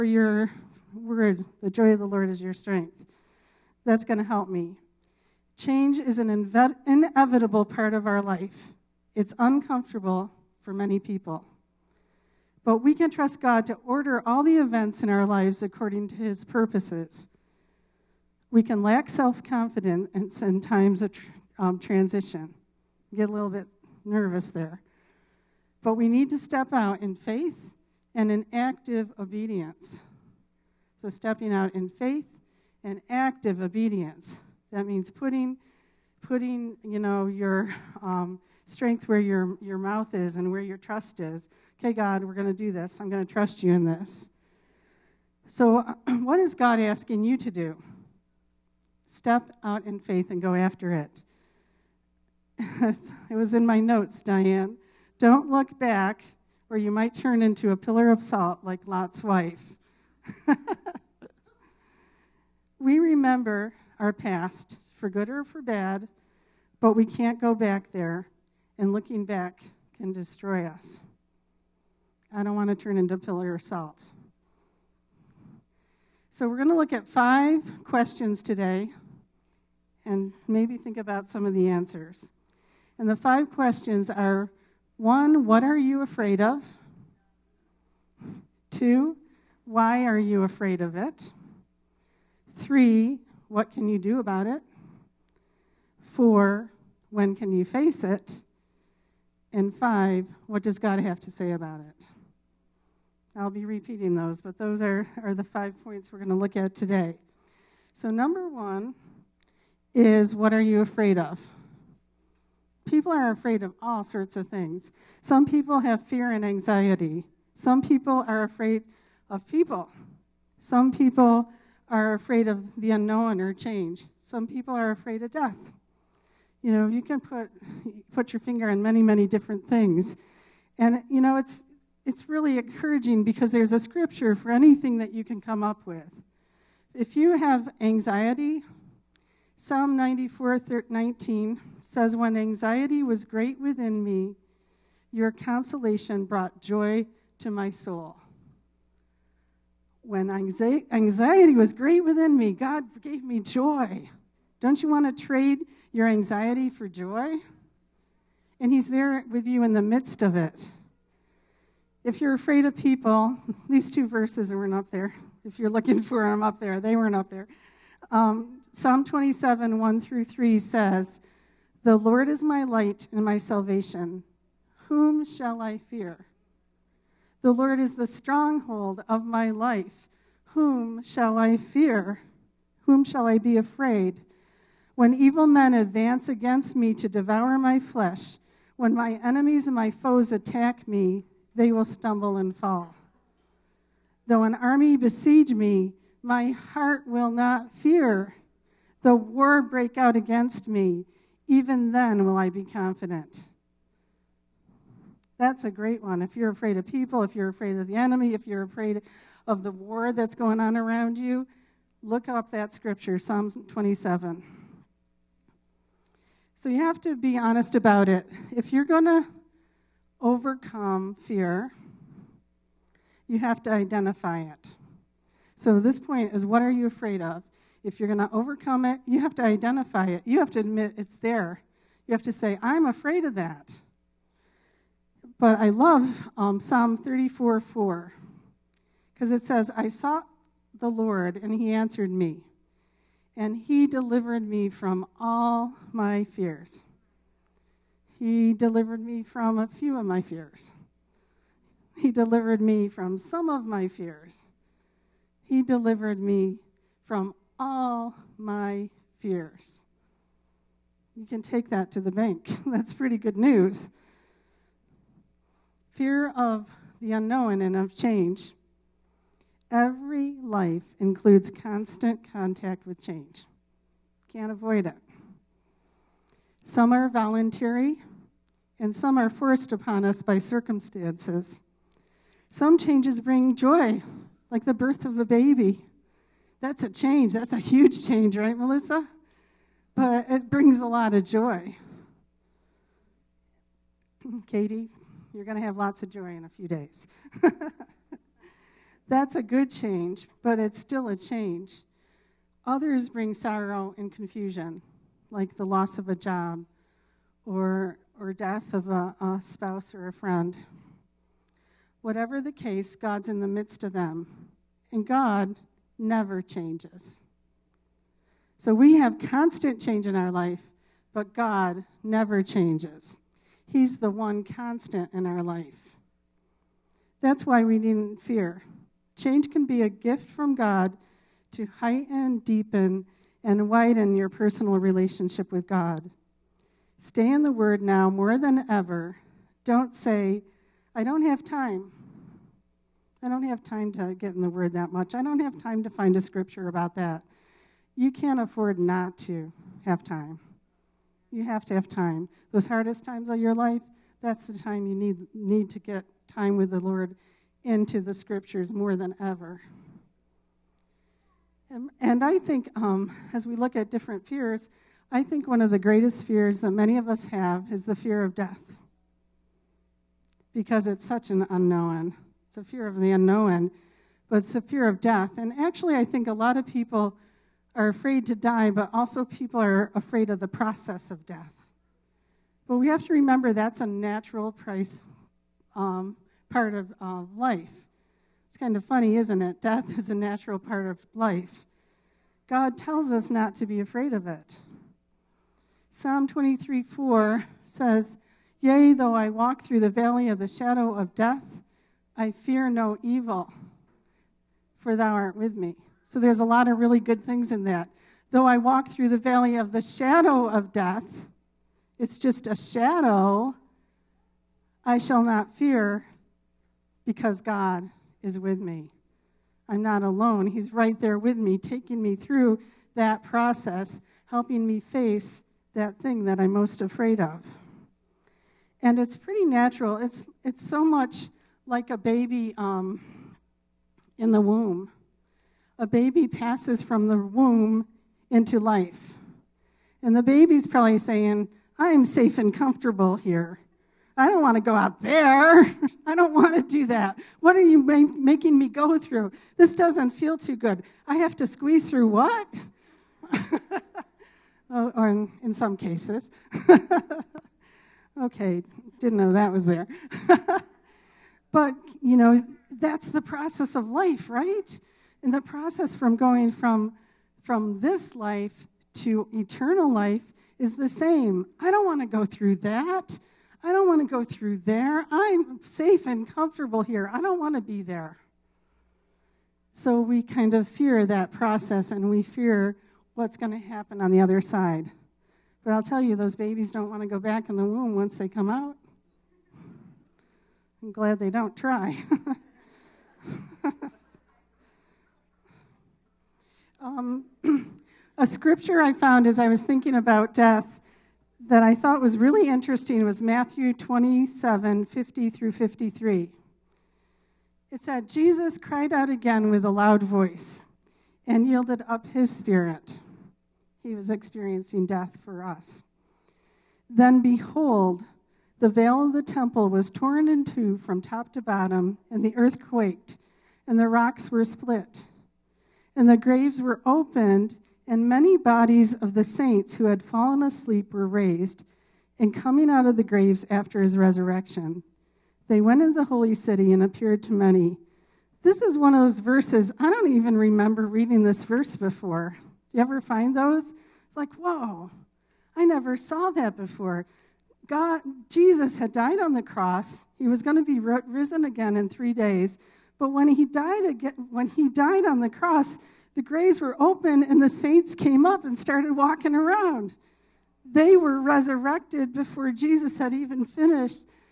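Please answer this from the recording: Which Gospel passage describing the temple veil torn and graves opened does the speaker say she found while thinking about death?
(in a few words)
Matthew 27:50-53.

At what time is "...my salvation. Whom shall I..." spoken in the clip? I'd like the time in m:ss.
2:53.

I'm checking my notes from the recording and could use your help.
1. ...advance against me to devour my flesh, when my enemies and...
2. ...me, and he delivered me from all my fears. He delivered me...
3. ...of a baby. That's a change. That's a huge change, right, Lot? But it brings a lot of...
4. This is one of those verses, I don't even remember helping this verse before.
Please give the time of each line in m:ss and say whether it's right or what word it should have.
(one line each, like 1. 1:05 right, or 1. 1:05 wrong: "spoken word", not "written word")
1. 3:05 right
2. 4:02 right
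3. 4:45 wrong: "Melissa", not "Lot"
4. 8:58 wrong: "reading", not "helping".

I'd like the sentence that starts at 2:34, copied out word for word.
Don't you want to trade your anxiety for joy?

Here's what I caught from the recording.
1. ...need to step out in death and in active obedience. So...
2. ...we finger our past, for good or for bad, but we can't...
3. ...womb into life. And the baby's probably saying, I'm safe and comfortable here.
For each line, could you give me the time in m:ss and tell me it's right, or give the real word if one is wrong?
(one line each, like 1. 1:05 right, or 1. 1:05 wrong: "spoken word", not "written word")
1. 0:26 wrong: "faith", not "death"
2. 1:02 wrong: "remember", not "finger"
3. 7:17 right.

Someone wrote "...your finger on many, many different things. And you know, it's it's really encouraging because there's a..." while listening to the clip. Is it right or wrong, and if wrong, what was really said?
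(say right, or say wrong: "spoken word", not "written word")
right.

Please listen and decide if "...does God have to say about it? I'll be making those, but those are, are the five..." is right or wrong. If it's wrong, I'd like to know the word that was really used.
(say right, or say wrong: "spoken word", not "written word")
wrong: "repeating", not "making".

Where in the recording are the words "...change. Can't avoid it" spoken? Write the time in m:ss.
4:33.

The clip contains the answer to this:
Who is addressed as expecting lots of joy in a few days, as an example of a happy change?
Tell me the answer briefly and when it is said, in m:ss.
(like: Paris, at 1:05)
Katie, at 4:54.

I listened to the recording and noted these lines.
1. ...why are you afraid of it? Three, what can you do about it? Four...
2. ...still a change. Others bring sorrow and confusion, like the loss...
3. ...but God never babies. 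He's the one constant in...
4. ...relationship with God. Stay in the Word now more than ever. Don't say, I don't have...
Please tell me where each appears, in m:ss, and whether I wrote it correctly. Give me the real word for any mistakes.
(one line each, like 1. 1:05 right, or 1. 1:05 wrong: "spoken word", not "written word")
1. 1:29 right
2. 5:00 right
3. 5:21 wrong: "changes", not "babies"
4. 5:34 right.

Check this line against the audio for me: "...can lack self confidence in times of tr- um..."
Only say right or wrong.
right.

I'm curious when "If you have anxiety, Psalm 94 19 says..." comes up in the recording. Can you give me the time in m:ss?
2:16.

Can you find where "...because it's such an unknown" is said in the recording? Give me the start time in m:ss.
6:10.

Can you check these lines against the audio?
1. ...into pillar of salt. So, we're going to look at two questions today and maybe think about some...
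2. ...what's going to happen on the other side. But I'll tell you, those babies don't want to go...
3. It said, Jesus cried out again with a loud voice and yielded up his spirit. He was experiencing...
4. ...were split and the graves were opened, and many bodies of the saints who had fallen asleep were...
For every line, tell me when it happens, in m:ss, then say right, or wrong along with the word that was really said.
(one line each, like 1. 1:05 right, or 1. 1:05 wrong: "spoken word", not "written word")
1. 1:12 wrong: "five", not "two"
2. 8:03 right
3. 8:27 right
4. 8:44 right.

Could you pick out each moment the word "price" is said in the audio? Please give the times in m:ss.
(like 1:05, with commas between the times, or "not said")
6:24.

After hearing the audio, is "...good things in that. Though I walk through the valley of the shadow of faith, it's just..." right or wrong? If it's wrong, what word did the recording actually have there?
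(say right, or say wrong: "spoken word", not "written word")
wrong: "death", not "faith".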